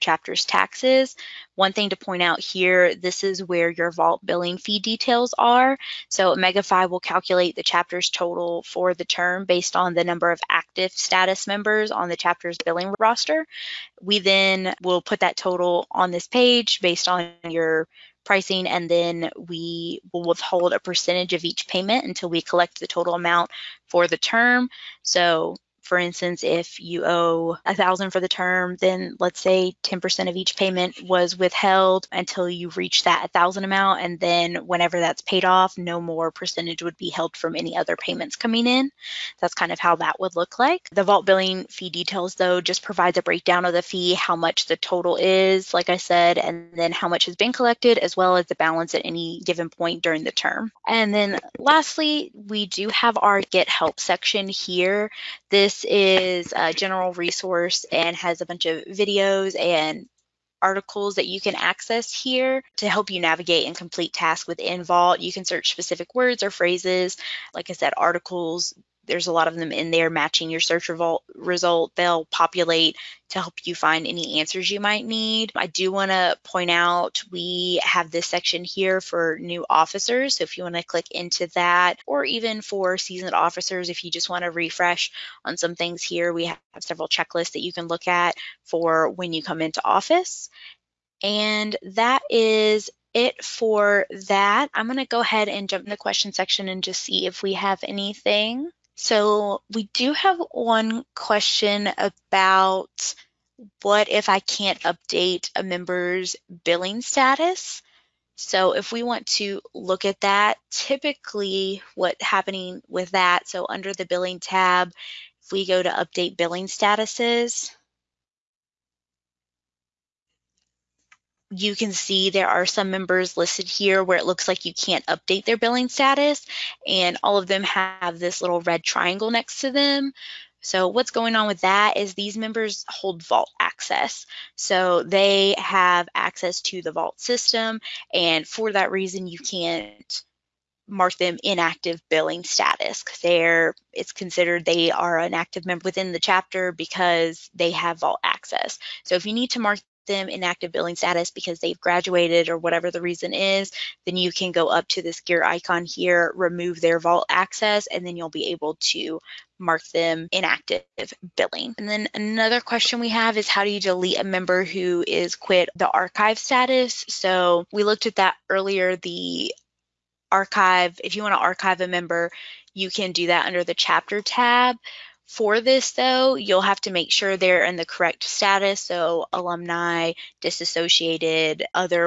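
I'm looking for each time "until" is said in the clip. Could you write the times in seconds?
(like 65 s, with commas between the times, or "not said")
22 s, 32 s.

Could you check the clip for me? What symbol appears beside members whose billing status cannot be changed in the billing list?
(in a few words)
red triangle.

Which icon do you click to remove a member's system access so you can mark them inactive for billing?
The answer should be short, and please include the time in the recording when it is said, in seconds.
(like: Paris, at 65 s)
gear icon, at 155 s.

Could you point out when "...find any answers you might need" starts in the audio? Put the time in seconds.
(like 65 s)
73 s.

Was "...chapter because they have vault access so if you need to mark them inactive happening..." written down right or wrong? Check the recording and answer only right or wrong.
wrong.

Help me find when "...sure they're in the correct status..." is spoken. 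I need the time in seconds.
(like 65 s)
177 s.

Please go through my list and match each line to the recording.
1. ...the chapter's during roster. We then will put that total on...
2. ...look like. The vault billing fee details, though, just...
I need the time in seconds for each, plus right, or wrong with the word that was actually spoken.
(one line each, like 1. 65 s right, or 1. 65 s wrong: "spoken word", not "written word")
1. 12 s wrong: "billing", not "during"
2. 40 s right.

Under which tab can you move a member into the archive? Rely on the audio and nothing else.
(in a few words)
chapter tab.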